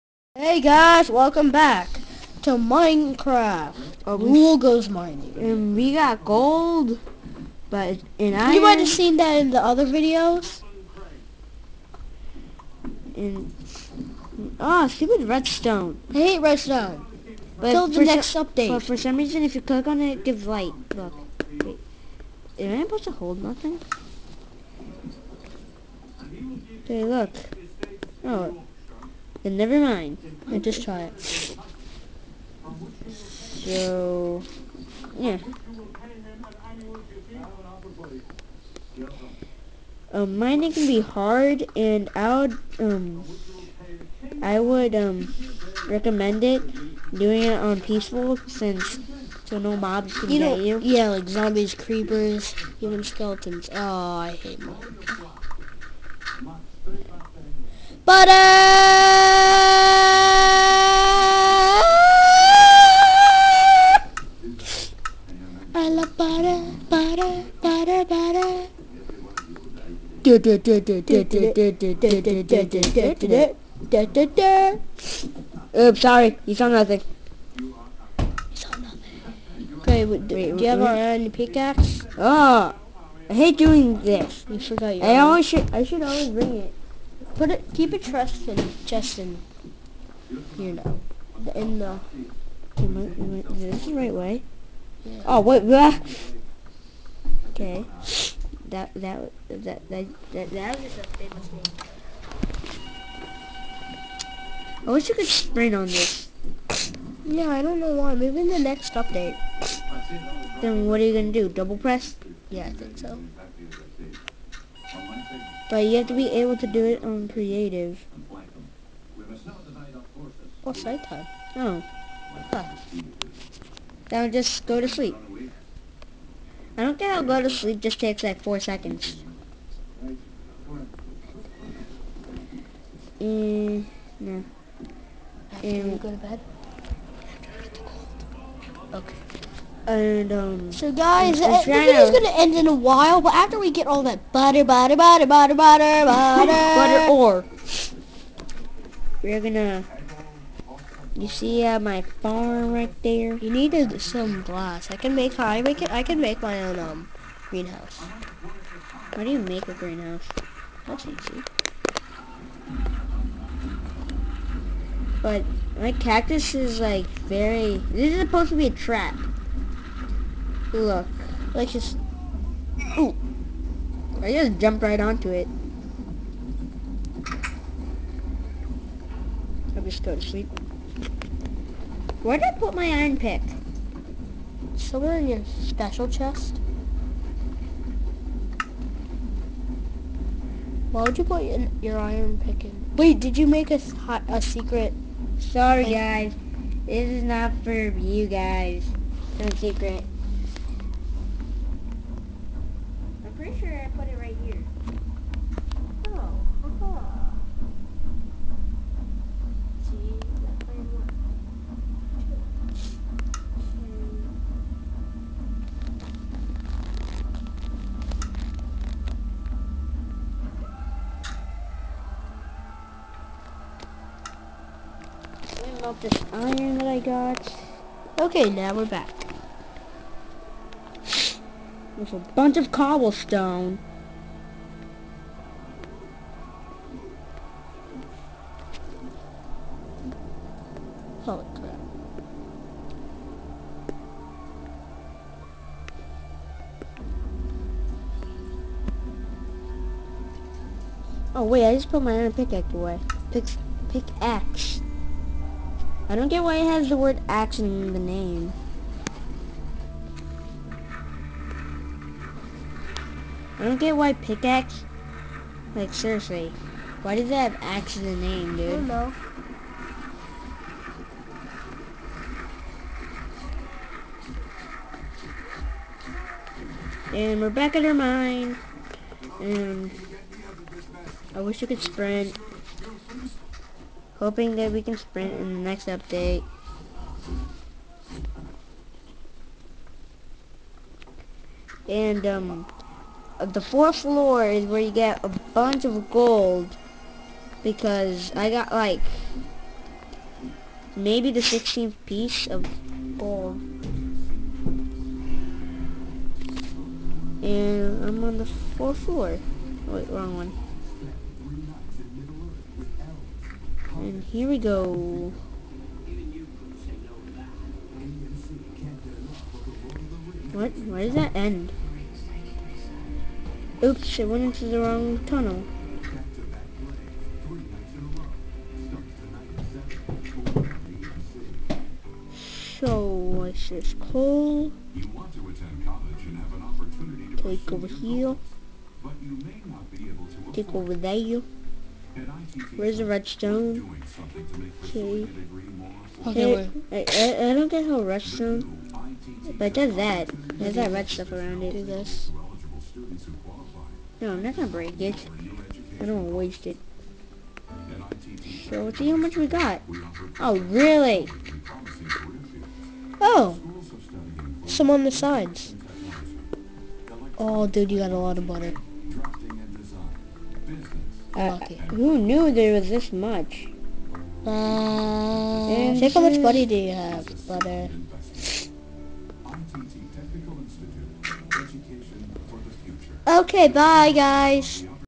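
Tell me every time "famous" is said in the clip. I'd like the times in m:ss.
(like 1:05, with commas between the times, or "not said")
1:41.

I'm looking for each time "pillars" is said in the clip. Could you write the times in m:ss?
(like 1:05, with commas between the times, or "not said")
not said.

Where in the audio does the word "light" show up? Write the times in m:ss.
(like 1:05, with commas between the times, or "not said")
0:20.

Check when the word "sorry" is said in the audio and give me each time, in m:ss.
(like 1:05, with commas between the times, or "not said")
1:16, 3:15.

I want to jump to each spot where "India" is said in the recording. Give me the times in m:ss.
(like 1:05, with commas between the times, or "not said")
not said.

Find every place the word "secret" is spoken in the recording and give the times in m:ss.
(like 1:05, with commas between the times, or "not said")
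3:14, 3:19.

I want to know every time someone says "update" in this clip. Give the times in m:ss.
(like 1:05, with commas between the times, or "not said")
0:18, 1:48, 4:45.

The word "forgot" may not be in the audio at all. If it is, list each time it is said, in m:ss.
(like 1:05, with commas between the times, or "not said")
1:24.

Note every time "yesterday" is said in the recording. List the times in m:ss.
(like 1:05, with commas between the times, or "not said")
not said.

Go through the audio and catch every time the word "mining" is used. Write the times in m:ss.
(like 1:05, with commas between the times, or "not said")
0:04, 0:40.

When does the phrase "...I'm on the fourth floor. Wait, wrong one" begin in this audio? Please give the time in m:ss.
5:08.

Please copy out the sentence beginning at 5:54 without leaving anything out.
No, I'm not gonna break it.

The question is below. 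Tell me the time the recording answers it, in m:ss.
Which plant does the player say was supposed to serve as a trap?
2:45.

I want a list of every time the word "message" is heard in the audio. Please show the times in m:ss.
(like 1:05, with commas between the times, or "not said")
not said.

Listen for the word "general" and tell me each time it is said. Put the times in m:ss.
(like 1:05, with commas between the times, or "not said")
not said.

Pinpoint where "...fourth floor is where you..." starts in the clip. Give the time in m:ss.
4:53.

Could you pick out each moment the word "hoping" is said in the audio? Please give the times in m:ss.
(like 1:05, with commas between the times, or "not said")
4:44.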